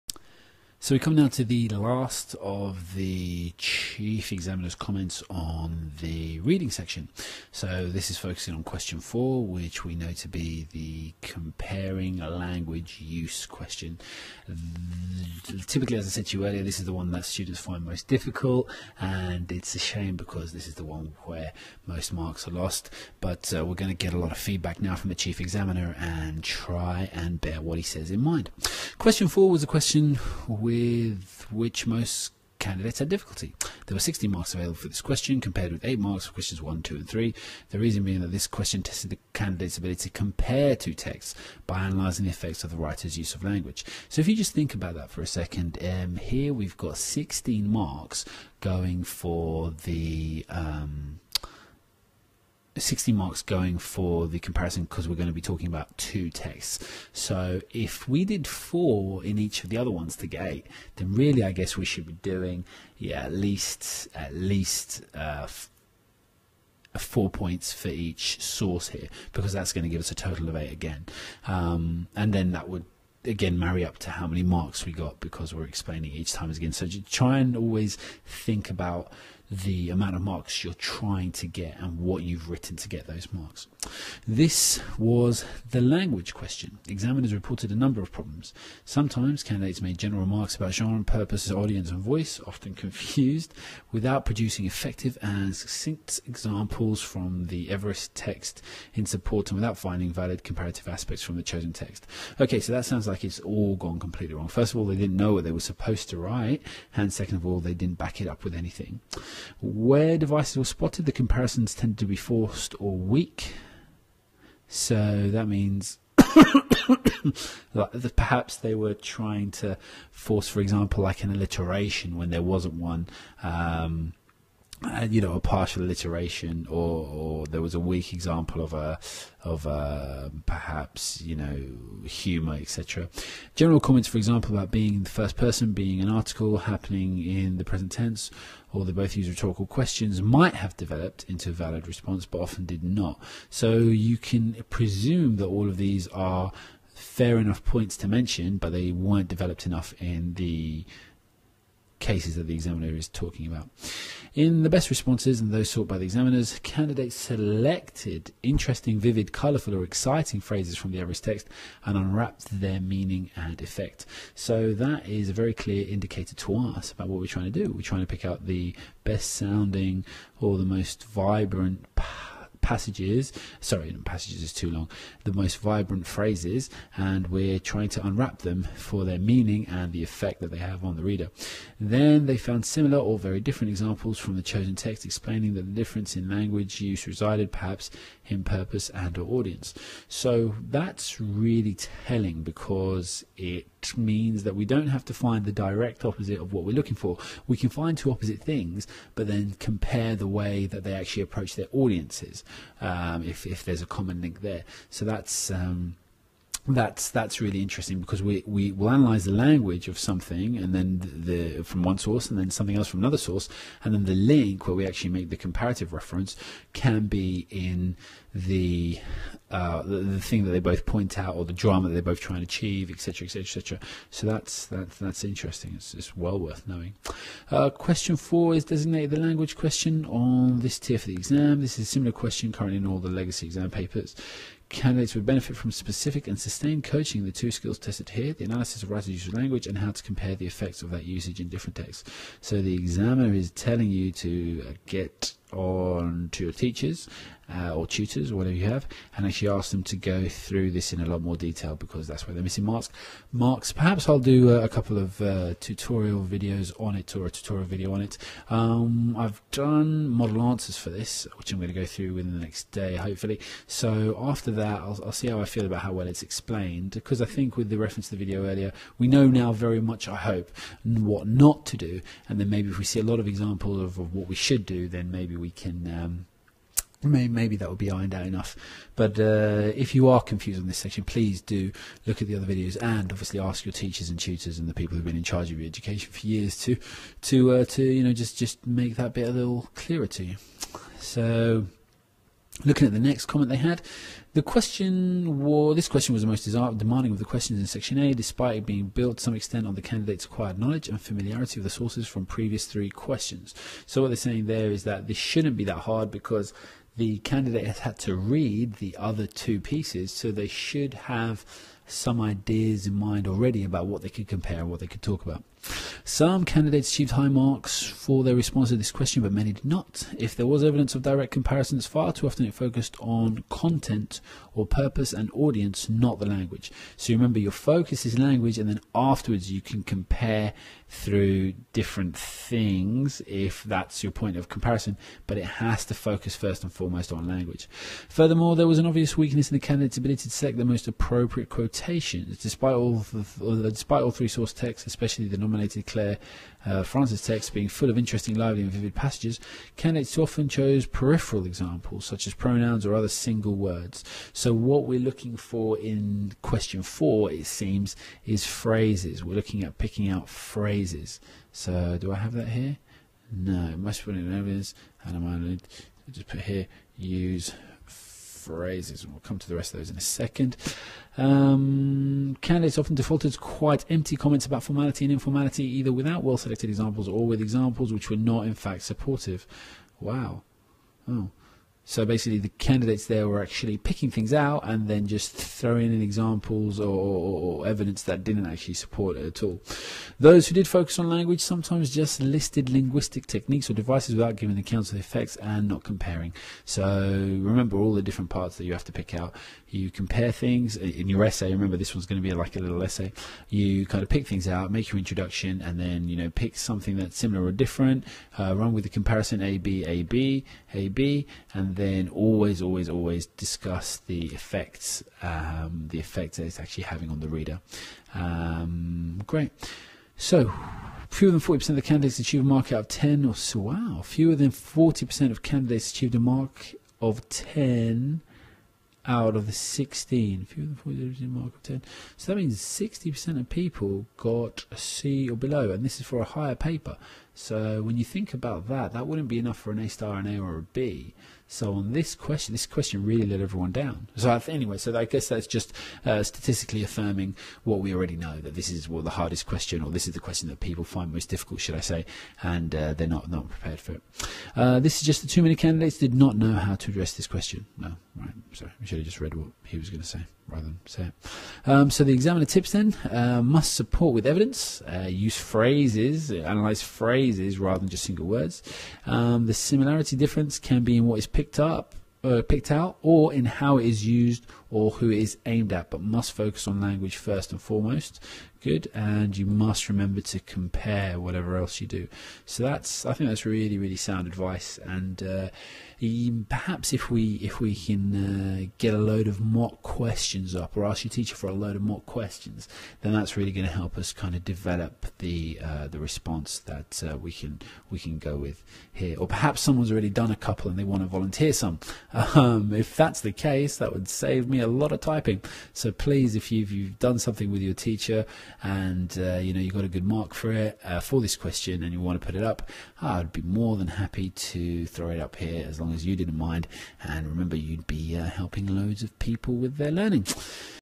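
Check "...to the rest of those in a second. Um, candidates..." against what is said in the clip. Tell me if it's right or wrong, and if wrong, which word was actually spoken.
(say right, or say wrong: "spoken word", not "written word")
right.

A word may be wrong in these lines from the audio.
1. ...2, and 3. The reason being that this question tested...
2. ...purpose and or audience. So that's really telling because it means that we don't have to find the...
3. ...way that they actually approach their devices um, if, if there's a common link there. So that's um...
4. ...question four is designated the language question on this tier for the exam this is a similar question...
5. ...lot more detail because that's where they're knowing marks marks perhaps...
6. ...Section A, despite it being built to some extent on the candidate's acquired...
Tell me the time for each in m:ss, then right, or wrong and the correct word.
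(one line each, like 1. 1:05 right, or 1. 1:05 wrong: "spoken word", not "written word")
1. 0:36 right
2. 3:08 right
3. 3:20 wrong: "audiences", not "devices"
4. 3:47 right
5. 4:11 wrong: "missing", not "knowing"
6. 4:57 right.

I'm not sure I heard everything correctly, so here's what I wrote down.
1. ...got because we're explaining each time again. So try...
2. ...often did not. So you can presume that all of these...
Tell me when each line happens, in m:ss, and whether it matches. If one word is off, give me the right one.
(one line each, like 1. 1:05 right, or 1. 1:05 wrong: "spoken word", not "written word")
1. 1:14 right
2. 2:22 right.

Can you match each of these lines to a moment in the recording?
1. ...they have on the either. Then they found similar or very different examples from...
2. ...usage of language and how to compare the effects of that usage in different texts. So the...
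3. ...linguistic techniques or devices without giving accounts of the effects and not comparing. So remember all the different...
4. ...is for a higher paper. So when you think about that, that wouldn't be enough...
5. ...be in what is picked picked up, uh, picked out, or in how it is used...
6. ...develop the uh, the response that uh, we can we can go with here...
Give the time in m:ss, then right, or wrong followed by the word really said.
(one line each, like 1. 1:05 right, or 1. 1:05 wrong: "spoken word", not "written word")
1. 3:00 wrong: "reader", not "either"
2. 3:59 right
3. 6:32 right
4. 7:15 right
5. 7:50 right
6. 8:14 right.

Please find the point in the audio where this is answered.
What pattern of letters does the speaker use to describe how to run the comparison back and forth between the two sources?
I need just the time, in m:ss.
6:49.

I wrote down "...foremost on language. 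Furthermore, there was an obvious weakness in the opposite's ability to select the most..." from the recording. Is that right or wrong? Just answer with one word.
wrong.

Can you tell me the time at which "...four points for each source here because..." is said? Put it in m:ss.
1:06.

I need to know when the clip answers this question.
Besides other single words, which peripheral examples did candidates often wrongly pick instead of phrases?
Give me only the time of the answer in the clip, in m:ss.
5:52.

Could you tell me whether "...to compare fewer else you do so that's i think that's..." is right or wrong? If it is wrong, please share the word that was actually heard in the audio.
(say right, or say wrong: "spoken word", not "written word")
wrong: "whatever", not "fewer".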